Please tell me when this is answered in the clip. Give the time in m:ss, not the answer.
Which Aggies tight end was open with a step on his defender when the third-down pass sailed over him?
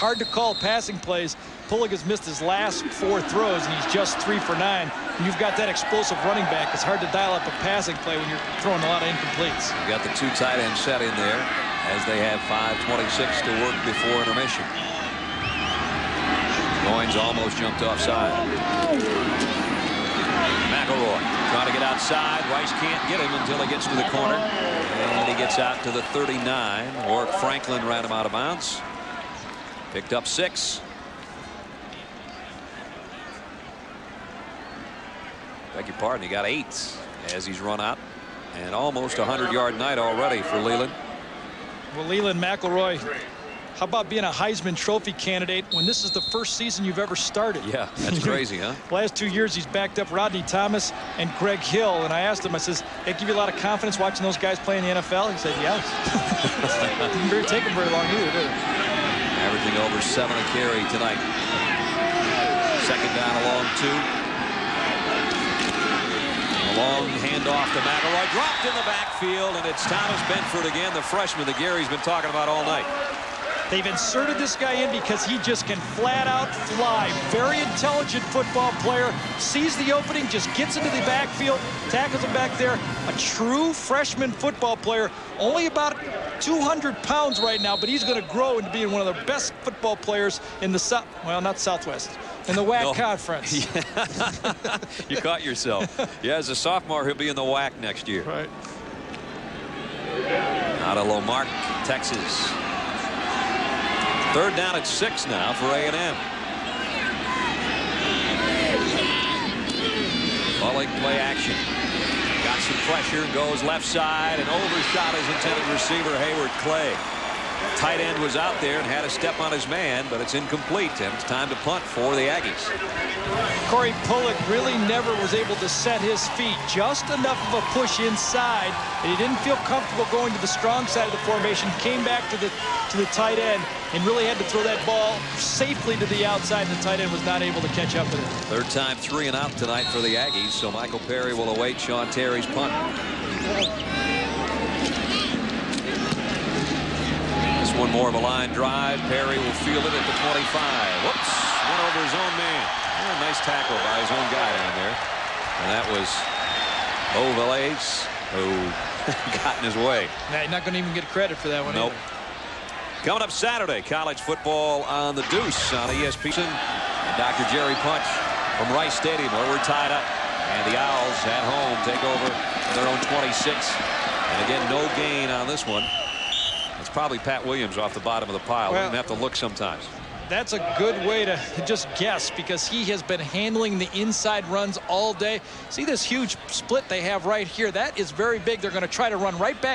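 1:56.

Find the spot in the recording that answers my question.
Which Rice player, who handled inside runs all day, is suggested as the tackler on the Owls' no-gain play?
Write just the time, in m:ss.
2:57.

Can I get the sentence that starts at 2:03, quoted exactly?
Corey Pullig really never was able to set his feet.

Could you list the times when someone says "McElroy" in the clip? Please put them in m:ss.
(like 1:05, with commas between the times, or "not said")
0:20, 0:42, 1:07.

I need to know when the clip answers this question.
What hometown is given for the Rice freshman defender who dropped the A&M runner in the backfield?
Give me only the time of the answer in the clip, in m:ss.
1:41.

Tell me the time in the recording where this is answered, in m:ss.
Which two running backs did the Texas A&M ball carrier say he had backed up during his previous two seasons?
0:50.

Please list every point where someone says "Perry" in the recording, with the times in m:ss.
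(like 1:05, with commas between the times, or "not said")
2:20, 2:29.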